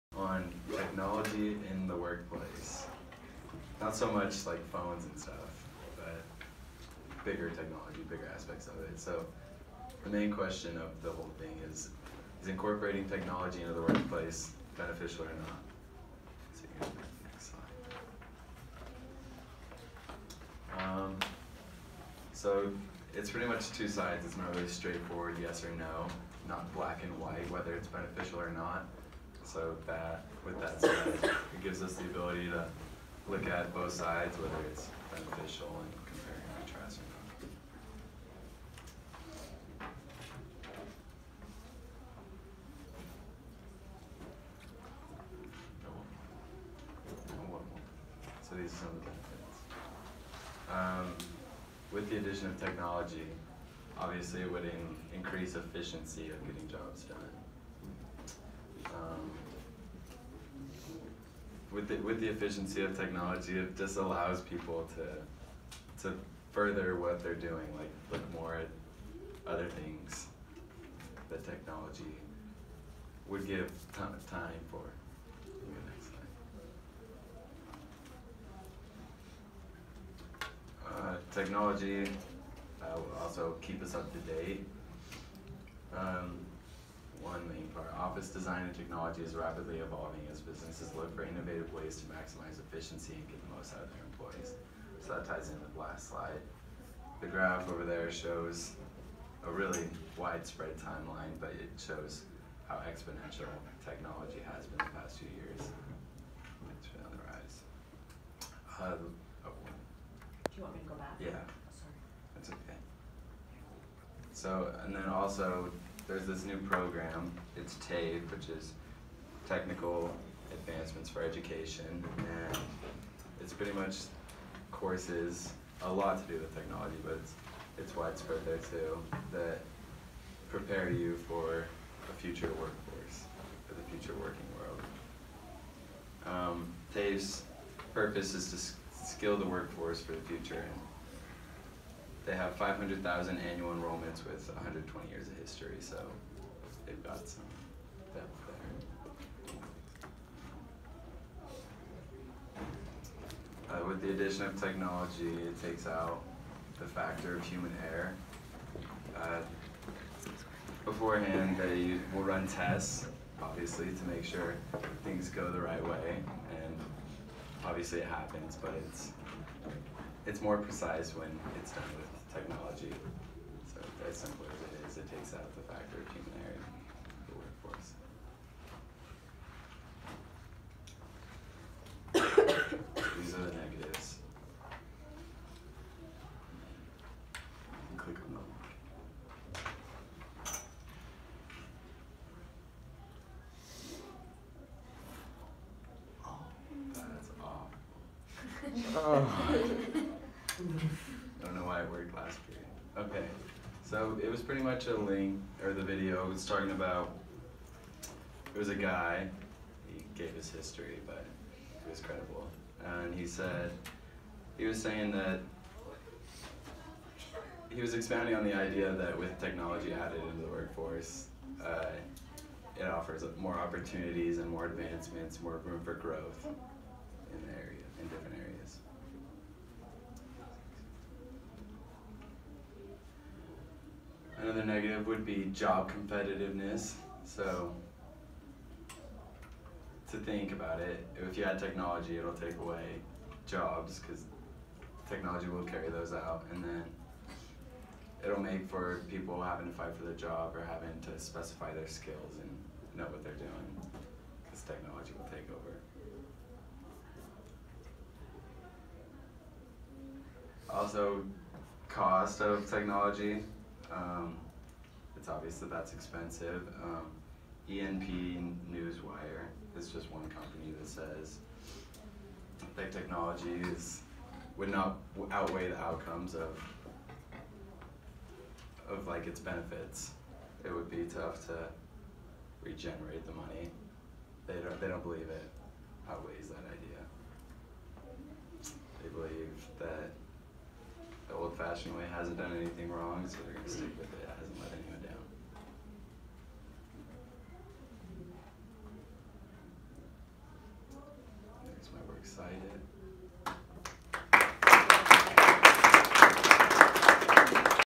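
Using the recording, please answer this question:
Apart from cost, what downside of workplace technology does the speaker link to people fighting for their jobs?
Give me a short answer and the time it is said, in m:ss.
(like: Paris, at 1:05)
job competitiveness, at 3:55.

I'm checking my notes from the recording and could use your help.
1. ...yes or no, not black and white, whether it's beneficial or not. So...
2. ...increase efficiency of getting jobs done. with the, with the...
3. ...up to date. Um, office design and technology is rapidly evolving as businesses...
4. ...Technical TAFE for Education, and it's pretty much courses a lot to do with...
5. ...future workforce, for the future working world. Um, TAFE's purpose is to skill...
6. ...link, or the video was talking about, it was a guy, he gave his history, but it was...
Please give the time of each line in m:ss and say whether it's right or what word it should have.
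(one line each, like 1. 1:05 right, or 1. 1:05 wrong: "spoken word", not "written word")
1. 0:25 right
2. 0:55 right
3. 1:23 right
4. 1:59 wrong: "Advancements", not "TAFE"
5. 2:12 right
6. 3:24 right.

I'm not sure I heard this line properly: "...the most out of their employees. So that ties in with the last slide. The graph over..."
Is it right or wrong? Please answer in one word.
right.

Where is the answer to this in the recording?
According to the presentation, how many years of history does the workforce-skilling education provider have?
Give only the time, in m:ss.
2:24.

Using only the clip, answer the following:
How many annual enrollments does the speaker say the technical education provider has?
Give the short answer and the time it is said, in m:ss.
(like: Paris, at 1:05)
500,000, at 2:22.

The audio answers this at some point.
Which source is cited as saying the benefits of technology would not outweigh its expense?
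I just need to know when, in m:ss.
4:27.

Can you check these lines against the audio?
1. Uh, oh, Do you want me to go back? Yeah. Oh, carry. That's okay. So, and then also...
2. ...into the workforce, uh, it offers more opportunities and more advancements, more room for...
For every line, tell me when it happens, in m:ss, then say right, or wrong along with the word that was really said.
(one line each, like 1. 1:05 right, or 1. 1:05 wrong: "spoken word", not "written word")
1. 1:48 wrong: "sorry", not "carry"
2. 3:40 right.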